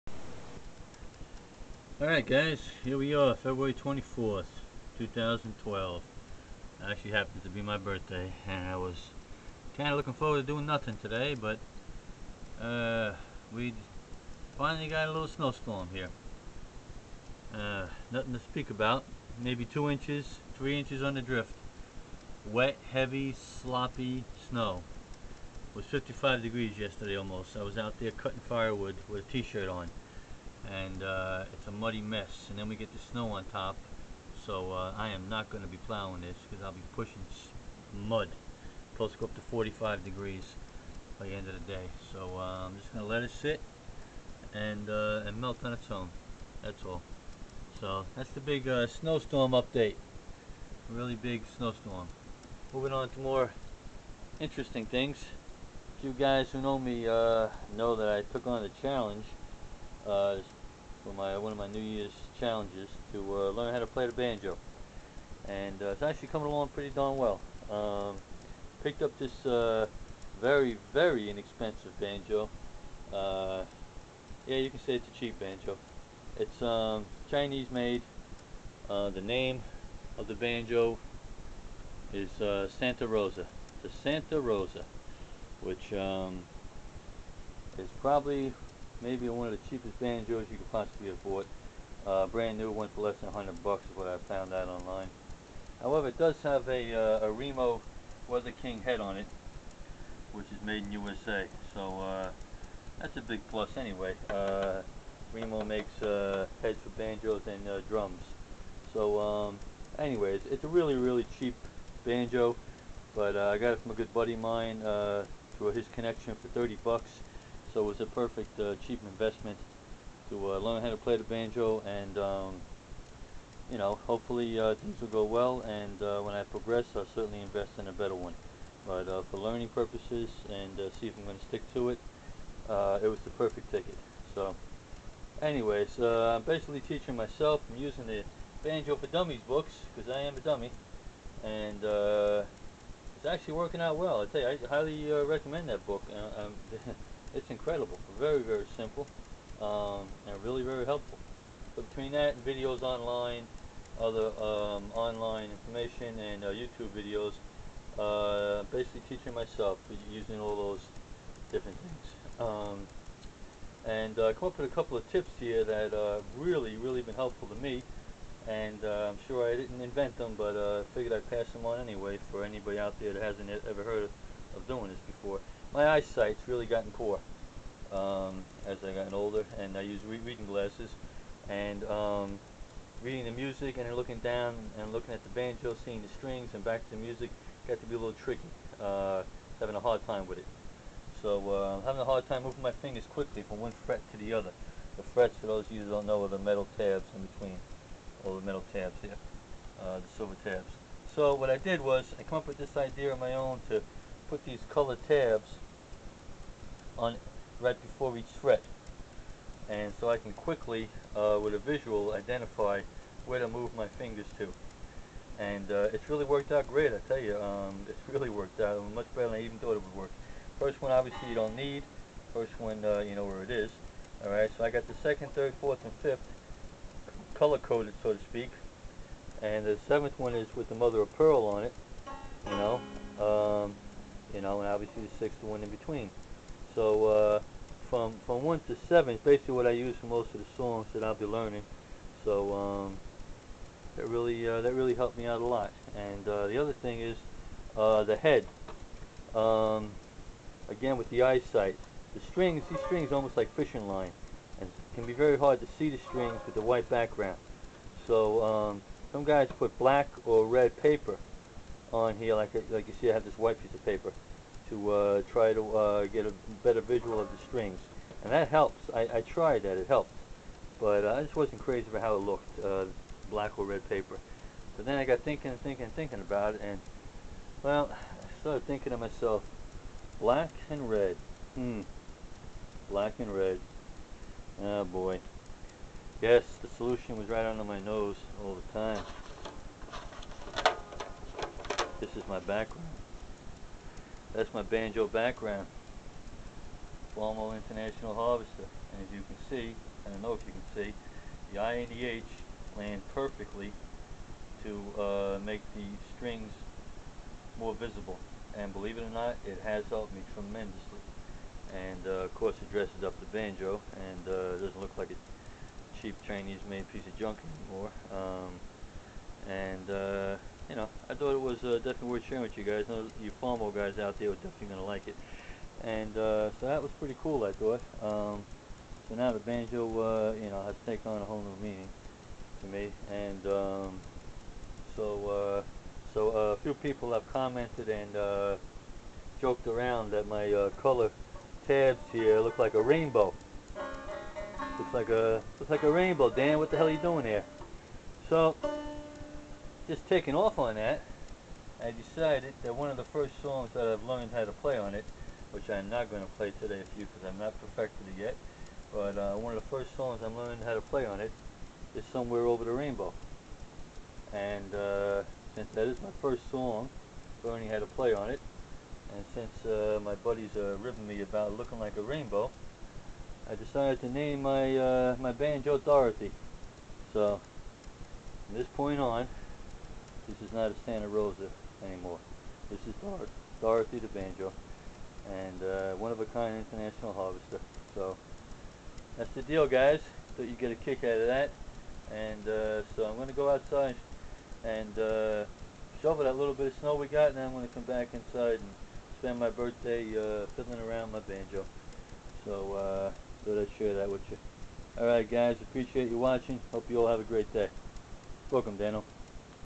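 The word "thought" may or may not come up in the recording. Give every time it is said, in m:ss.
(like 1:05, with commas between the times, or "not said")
3:39, 5:21, 5:27, 6:30, 6:43.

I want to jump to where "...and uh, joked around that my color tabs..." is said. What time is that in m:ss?
5:37.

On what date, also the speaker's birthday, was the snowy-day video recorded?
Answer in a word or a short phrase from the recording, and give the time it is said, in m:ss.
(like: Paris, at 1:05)
February 24th, at 0:03.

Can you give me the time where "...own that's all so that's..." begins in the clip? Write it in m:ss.
0:45.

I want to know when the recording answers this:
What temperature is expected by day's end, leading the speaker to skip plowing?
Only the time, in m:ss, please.
0:39.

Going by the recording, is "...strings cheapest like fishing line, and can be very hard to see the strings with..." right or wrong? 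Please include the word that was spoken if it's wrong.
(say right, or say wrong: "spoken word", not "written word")
wrong: "almost", not "cheapest".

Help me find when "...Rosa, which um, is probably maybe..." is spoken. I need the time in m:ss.
1:24.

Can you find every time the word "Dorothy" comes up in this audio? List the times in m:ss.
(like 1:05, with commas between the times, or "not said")
6:15, 6:23.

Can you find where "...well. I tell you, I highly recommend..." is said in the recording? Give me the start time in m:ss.
2:23.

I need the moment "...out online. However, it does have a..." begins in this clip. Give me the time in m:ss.
1:34.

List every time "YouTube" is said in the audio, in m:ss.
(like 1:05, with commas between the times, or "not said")
2:36.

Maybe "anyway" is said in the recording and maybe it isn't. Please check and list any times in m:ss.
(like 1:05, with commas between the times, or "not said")
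1:43, 1:49, 2:15, 2:51.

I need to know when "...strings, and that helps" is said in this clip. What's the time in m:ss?
4:27.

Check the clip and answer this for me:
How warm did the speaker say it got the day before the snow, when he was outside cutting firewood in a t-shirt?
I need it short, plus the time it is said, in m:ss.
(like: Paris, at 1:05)
55 degrees, at 0:25.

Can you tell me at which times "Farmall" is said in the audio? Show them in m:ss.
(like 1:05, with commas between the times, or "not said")
4:57, 5:23.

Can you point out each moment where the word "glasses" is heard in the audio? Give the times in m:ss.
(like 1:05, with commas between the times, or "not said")
3:00.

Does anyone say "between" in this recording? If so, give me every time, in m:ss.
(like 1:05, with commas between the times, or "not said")
2:31, 3:17, 3:55.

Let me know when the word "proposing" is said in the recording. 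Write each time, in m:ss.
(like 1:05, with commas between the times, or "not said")
not said.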